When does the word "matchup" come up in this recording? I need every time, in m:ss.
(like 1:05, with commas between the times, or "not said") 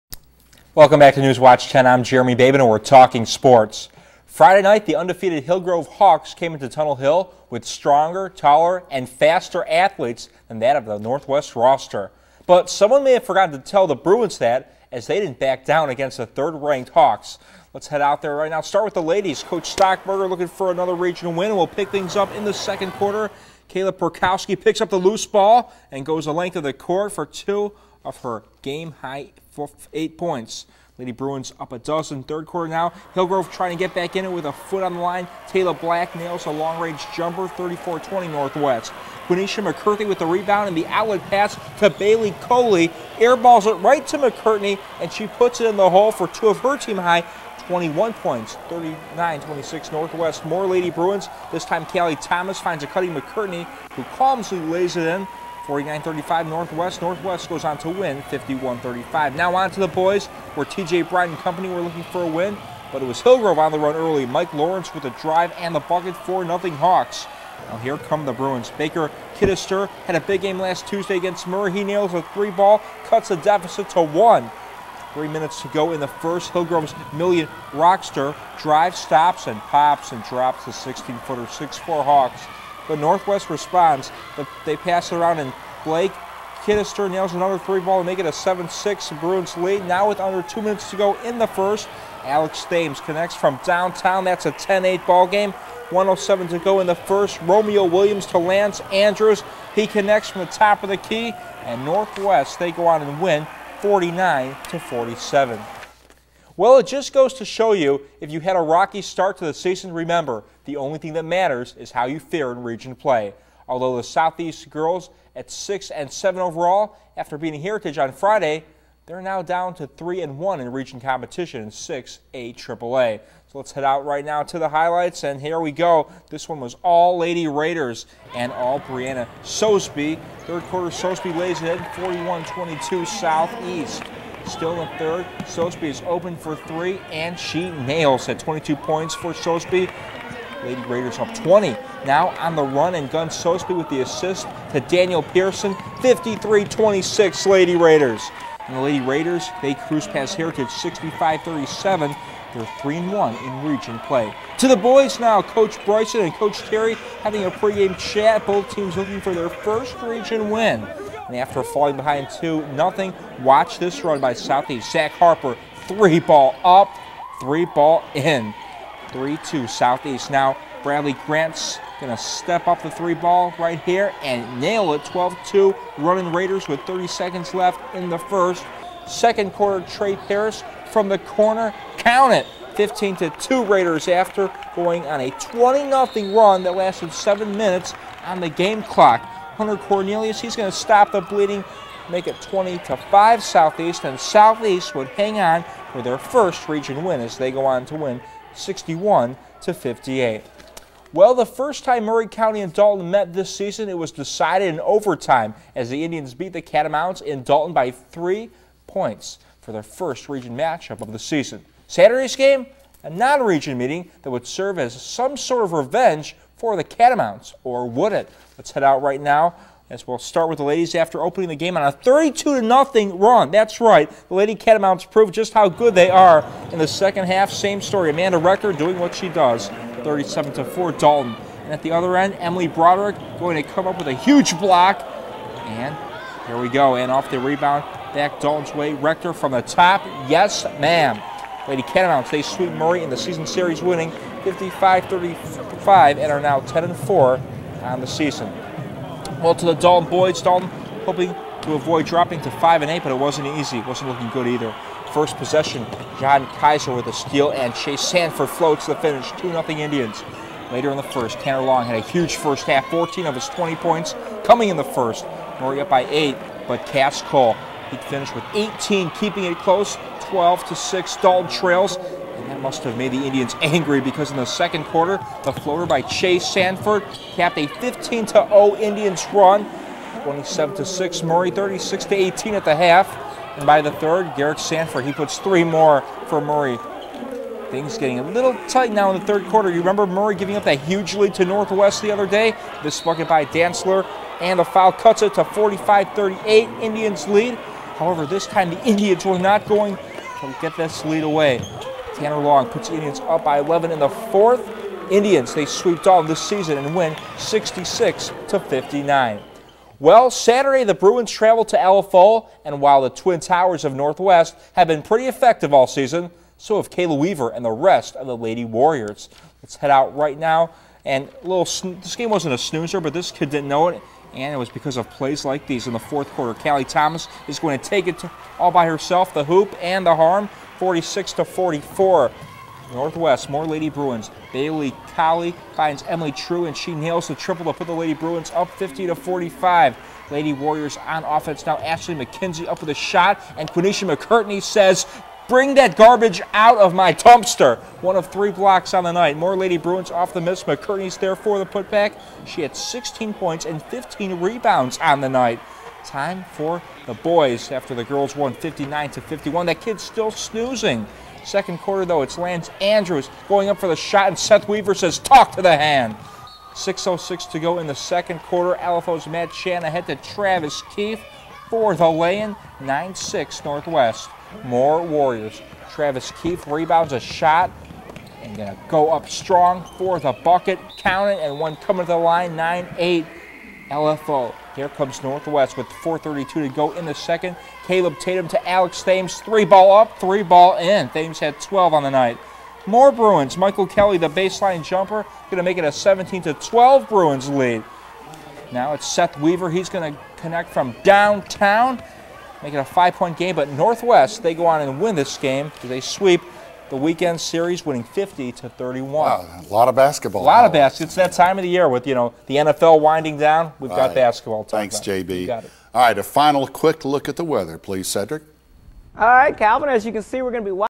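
3:30.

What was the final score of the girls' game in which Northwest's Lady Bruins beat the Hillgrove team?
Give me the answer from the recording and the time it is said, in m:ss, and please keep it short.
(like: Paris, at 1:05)
51-35, at 0:58.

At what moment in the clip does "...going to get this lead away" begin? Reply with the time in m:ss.
4:59.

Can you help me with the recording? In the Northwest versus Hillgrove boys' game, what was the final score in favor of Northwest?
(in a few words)
49 to 47.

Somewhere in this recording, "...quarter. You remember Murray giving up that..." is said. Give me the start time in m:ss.
4:49.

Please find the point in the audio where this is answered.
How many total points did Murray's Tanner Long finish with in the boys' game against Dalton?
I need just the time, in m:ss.
4:23.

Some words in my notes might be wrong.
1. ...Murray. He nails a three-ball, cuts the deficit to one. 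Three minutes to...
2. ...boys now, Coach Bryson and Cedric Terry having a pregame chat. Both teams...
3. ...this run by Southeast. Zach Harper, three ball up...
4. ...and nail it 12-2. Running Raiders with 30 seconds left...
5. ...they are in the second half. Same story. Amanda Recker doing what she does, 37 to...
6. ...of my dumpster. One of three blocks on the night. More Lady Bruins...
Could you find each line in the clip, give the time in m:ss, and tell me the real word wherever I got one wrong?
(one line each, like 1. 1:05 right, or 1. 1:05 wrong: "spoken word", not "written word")
1. 1:11 right
2. 2:34 wrong: "Coach", not "Cedric"
3. 2:43 right
4. 2:54 right
5. 3:45 right
6. 5:46 right.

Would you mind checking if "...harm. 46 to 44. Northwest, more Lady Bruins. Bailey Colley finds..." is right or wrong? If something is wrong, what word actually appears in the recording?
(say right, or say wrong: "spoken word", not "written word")
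right.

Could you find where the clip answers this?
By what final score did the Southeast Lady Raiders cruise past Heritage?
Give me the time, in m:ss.
2:30.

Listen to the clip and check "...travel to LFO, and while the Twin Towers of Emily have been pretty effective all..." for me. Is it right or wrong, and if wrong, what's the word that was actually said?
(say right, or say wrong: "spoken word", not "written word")
wrong: "Northwest", not "Emily".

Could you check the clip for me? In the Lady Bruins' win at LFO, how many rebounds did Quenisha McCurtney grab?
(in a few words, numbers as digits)
15.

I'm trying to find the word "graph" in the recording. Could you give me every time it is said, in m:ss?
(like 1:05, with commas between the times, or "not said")
not said.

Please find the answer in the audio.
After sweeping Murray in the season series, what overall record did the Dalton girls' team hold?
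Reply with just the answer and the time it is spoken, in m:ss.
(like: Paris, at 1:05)
10 and 4, at 4:06.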